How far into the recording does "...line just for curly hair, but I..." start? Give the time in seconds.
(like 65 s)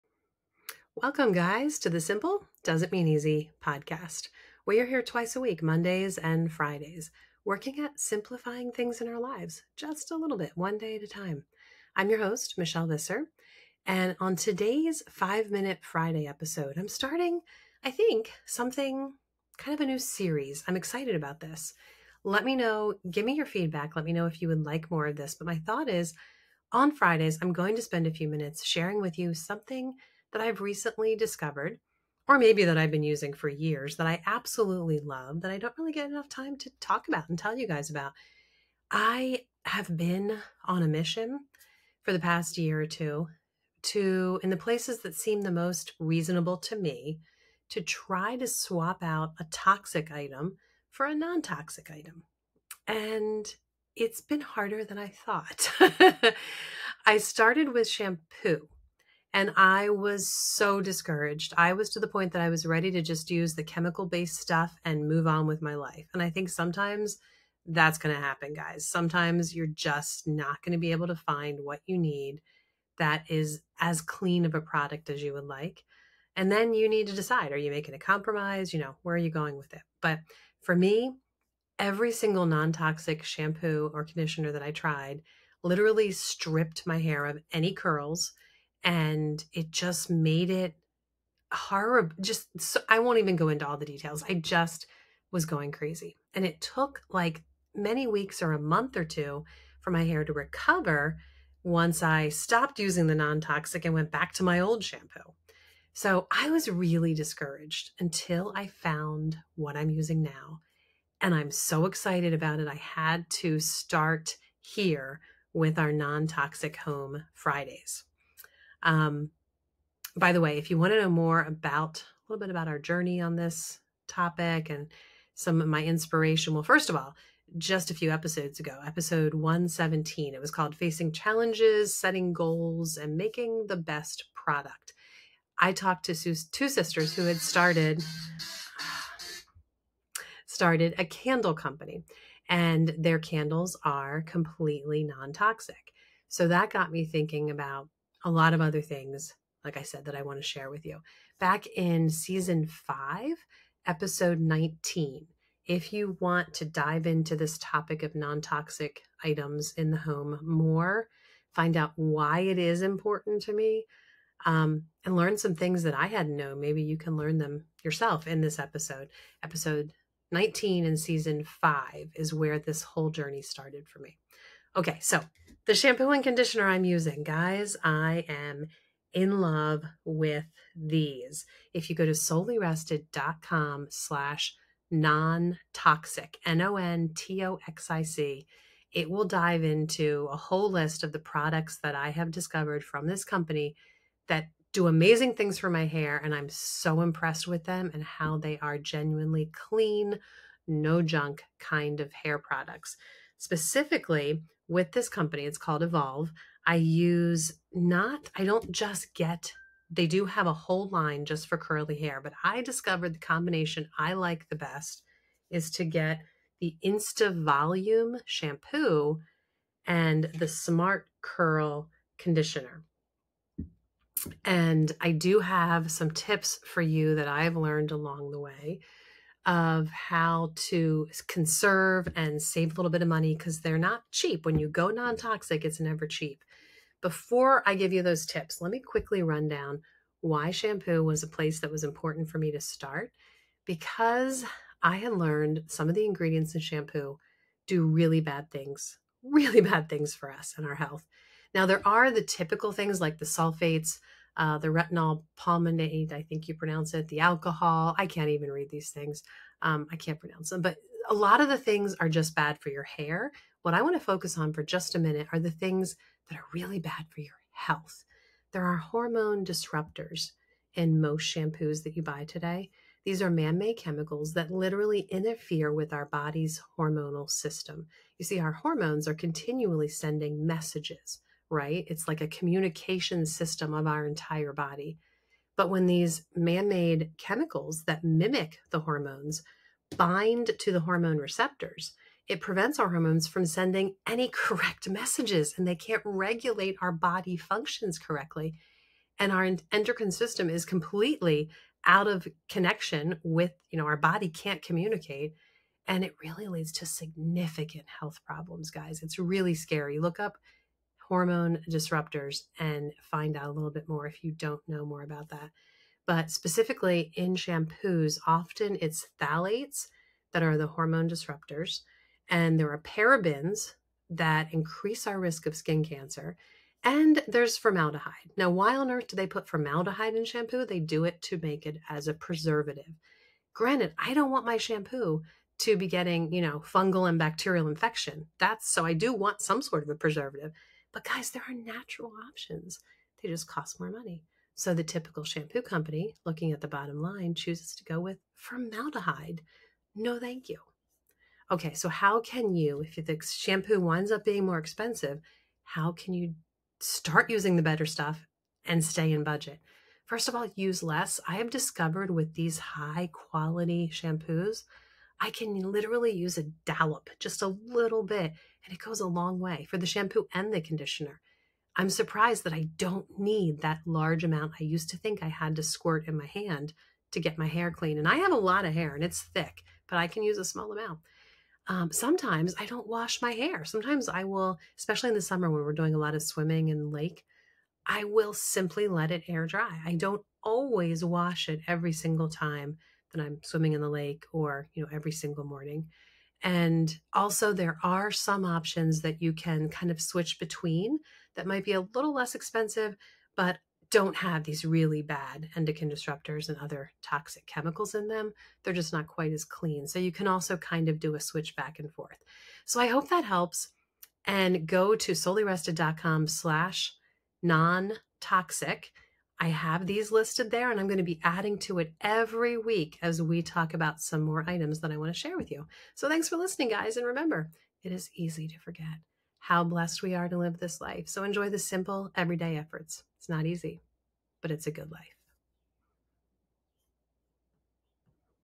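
210 s.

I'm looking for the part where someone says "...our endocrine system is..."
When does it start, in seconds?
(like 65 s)
299 s.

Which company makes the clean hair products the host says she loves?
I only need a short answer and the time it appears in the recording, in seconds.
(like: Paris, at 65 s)
Evolvh, at 205 s.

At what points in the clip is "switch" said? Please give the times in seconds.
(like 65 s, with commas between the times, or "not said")
400 s, 411 s.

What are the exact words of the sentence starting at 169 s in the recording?
Episode 19 in season five is where this whole journey started for me.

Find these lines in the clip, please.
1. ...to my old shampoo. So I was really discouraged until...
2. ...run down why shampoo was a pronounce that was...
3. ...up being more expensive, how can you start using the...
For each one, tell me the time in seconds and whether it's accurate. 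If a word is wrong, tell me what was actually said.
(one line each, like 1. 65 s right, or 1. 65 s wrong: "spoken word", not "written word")
1. 104 s right
2. 239 s wrong: "place", not "pronounce"
3. 354 s right.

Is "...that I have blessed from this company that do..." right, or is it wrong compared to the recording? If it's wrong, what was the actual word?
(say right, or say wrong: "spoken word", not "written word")
wrong: "discovered", not "blessed".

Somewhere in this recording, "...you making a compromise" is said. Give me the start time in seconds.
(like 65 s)
77 s.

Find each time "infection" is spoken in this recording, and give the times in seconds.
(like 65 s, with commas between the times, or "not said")
337 s.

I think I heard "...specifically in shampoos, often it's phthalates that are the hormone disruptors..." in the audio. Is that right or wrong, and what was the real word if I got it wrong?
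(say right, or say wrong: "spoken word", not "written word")
right.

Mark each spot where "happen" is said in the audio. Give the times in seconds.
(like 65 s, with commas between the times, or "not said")
68 s.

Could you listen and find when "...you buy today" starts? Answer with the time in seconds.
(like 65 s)
271 s.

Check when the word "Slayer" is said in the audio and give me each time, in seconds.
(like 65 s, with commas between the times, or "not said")
not said.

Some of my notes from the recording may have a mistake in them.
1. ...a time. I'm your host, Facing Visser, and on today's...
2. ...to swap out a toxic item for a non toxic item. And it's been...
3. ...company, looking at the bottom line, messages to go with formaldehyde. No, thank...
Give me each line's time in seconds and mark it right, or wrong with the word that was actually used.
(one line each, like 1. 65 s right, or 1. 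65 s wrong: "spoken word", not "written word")
1. 11 s wrong: "Michelle", not "Facing"
2. 48 s right
3. 345 s wrong: "chooses", not "messages".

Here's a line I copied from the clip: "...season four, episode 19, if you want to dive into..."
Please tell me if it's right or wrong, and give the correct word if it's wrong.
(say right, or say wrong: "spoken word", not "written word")
wrong: "five", not "four".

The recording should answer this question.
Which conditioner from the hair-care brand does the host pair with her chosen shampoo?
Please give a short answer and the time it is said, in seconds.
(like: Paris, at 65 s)
Smart Curl, at 220 s.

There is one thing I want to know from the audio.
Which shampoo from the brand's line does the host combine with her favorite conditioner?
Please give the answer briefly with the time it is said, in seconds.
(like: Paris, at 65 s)
Insta Volume, at 216 s.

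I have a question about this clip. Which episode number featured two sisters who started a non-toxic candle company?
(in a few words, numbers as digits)
117.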